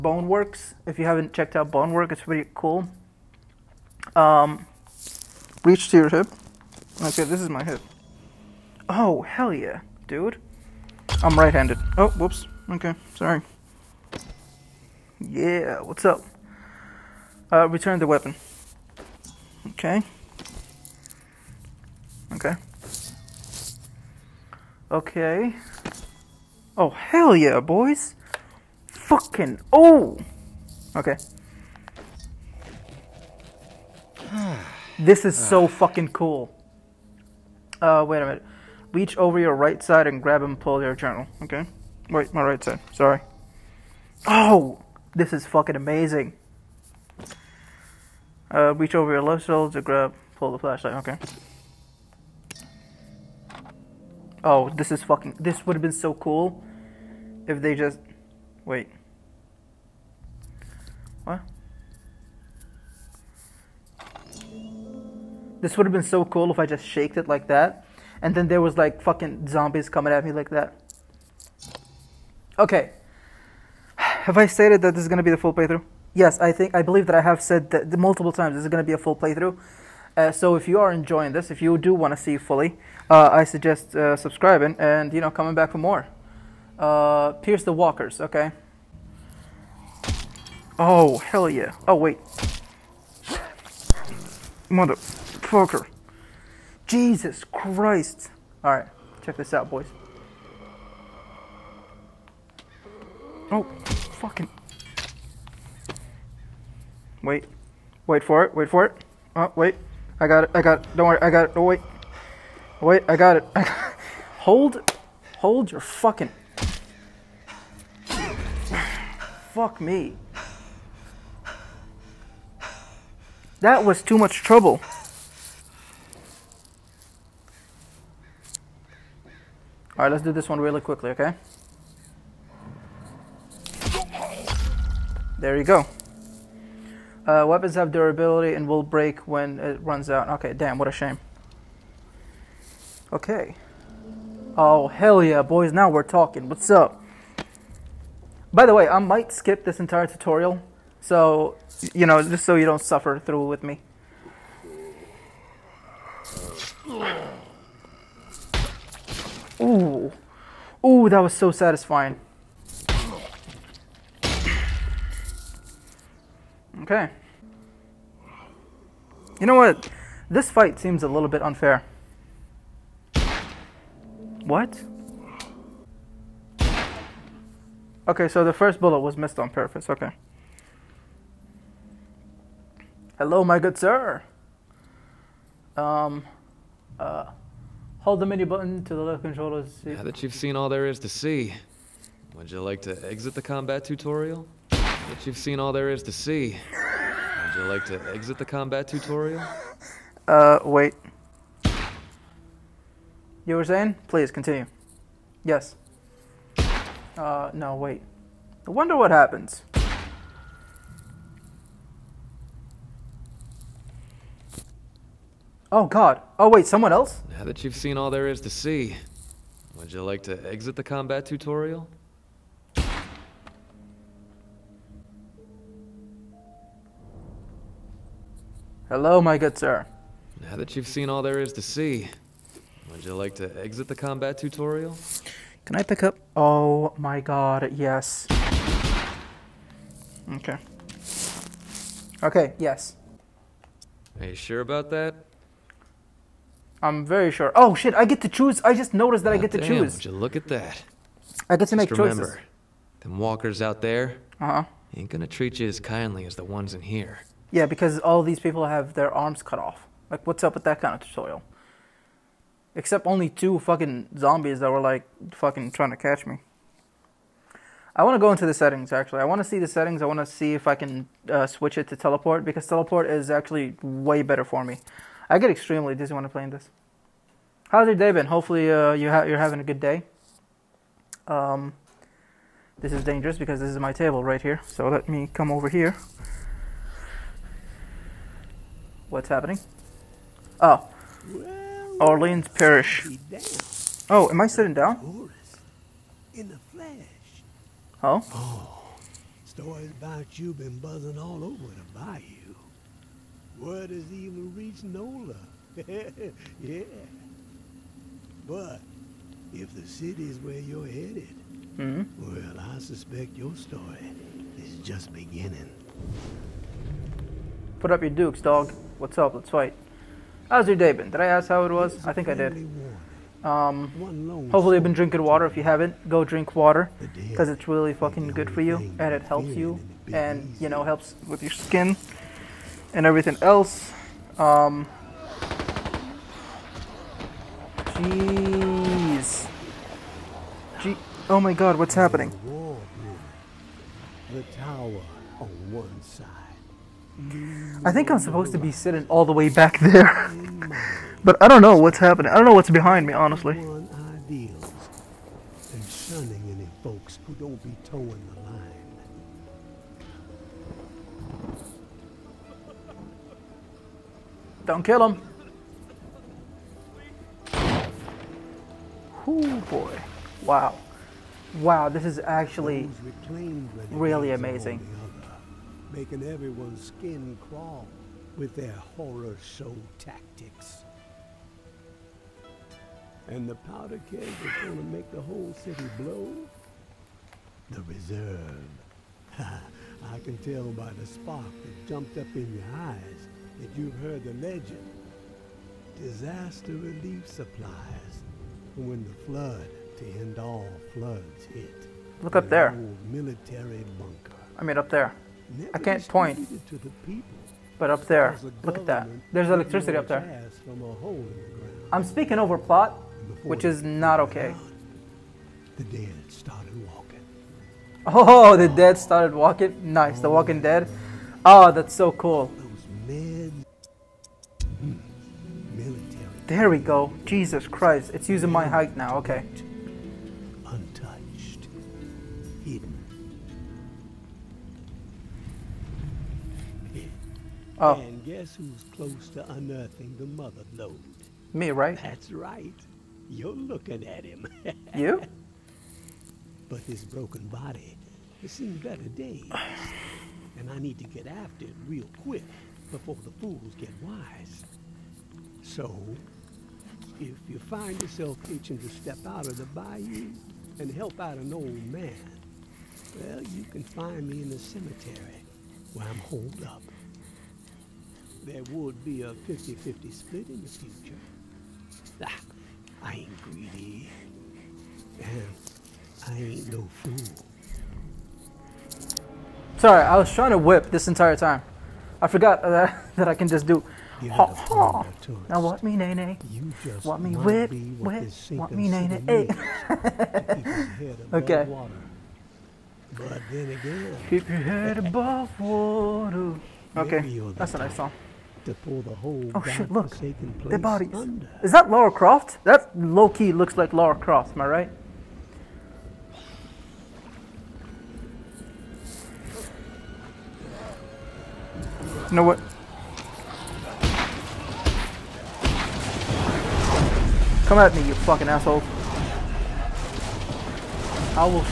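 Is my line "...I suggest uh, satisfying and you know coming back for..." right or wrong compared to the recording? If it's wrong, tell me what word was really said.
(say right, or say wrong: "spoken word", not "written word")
wrong: "subscribing", not "satisfying".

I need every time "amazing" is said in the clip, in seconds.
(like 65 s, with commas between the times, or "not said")
45 s, 374 s.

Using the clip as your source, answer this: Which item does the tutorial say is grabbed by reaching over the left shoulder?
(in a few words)
Flashlight.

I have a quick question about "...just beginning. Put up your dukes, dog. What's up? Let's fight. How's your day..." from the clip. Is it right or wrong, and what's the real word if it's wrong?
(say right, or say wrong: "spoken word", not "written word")
right.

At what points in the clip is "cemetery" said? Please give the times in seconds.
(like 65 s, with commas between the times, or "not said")
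464 s.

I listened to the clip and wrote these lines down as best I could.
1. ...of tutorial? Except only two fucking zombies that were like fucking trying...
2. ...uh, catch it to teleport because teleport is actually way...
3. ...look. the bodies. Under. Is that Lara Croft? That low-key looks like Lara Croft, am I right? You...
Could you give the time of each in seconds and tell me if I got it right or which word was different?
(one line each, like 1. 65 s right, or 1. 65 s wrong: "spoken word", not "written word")
1. 261 s right
2. 271 s wrong: "switch", not "catch"
3. 499 s right.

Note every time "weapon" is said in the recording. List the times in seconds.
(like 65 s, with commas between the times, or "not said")
18 s, 137 s.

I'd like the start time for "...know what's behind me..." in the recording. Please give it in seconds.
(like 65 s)
352 s.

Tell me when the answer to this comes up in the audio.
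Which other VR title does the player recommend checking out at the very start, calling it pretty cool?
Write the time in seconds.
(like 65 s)
0 s.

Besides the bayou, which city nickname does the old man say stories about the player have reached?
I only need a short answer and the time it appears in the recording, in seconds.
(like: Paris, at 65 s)
Nola, at 304 s.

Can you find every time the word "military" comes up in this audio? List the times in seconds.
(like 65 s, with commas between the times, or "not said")
403 s.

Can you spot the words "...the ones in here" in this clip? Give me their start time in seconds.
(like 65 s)
256 s.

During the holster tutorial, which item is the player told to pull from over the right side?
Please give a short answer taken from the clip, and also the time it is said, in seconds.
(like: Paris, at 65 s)
Journal, at 40 s.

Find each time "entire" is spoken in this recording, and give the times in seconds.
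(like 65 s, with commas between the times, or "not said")
149 s, 481 s.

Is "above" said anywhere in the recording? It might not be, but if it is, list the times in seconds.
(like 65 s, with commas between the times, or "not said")
494 s.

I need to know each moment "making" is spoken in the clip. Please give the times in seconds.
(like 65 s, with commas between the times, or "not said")
375 s.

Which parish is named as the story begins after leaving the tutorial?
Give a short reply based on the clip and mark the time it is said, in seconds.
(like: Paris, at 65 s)
Orleans Parish, at 292 s.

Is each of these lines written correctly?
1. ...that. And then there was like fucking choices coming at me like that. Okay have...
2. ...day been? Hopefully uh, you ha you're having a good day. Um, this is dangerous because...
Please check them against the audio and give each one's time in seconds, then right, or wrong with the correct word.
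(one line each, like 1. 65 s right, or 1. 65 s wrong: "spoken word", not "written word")
1. 67 s wrong: "zombies", not "choices"
2. 277 s right.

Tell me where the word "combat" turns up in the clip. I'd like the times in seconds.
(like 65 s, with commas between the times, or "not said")
193 s, 198 s, 220 s, 233 s.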